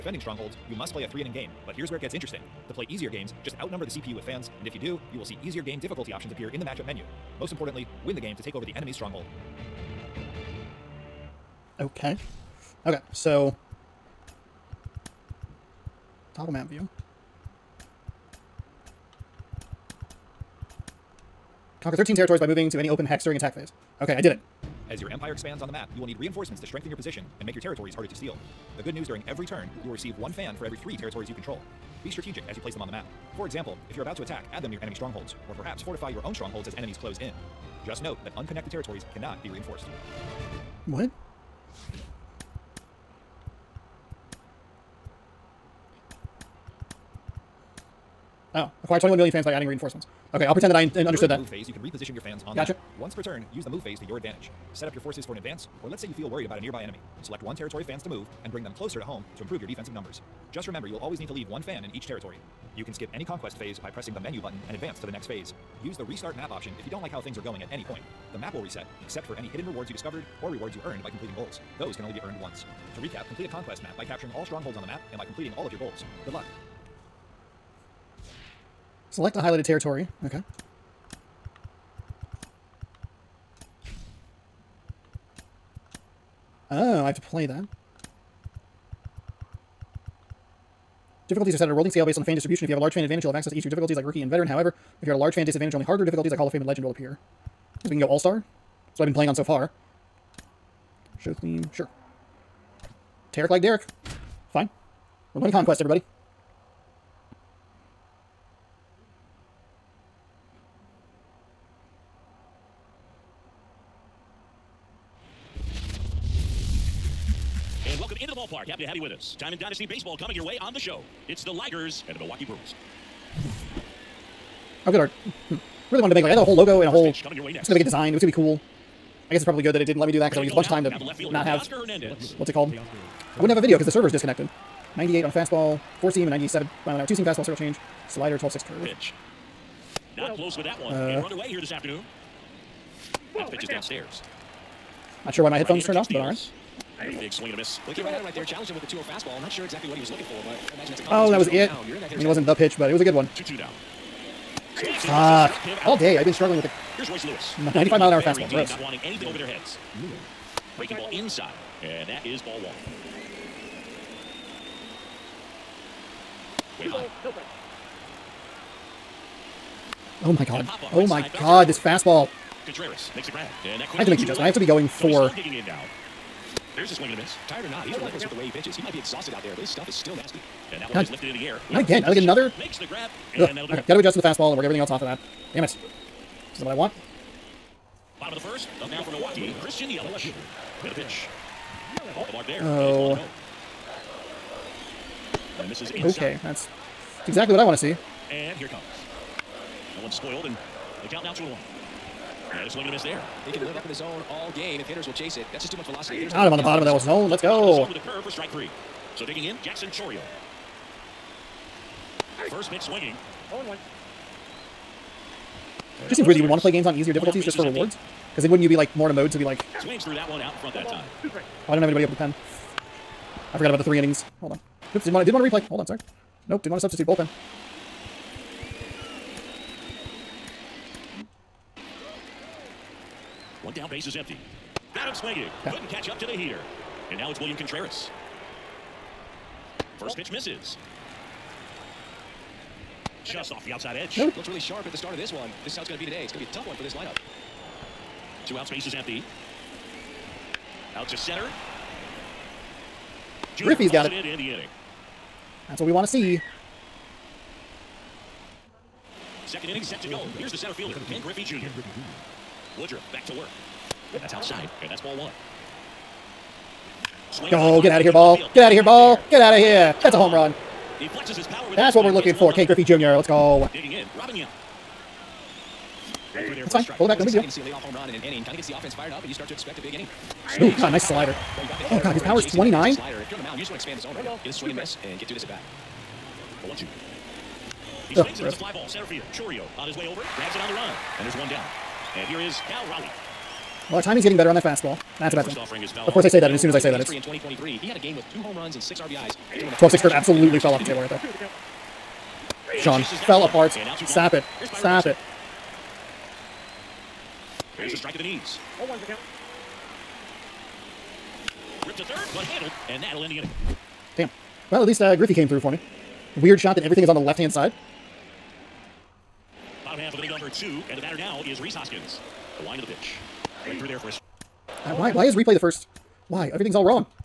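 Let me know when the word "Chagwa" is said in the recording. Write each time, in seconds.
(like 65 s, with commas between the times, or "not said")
not said.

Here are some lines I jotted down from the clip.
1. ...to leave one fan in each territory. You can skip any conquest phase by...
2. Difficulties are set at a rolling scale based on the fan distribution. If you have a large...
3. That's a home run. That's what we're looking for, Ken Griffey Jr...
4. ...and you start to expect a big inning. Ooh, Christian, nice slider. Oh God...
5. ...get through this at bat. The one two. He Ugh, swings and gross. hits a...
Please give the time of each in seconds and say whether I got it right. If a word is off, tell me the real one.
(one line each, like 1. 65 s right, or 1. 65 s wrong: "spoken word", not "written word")
1. 61 s right
2. 91 s right
3. 270 s right
4. 279 s wrong: "God", not "Christian"
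5. 285 s right.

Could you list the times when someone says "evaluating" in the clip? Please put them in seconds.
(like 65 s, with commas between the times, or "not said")
not said.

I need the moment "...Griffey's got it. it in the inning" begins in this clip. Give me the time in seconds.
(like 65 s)
253 s.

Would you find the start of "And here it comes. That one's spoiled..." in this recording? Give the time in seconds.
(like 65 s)
198 s.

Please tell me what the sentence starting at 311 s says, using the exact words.
Ripped to third, but handled, and that'll end the inning.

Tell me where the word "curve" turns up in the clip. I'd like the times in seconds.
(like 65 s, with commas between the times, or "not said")
138 s, 208 s, 300 s.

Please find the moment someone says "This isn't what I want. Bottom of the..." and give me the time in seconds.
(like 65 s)
186 s.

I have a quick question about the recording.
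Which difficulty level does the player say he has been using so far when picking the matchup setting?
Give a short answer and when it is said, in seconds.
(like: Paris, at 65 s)
All-Star, at 98 s.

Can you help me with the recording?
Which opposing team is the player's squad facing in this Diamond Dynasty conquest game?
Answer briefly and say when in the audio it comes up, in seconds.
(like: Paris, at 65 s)
Milwaukee Brewers, at 122 s.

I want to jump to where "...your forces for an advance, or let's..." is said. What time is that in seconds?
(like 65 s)
54 s.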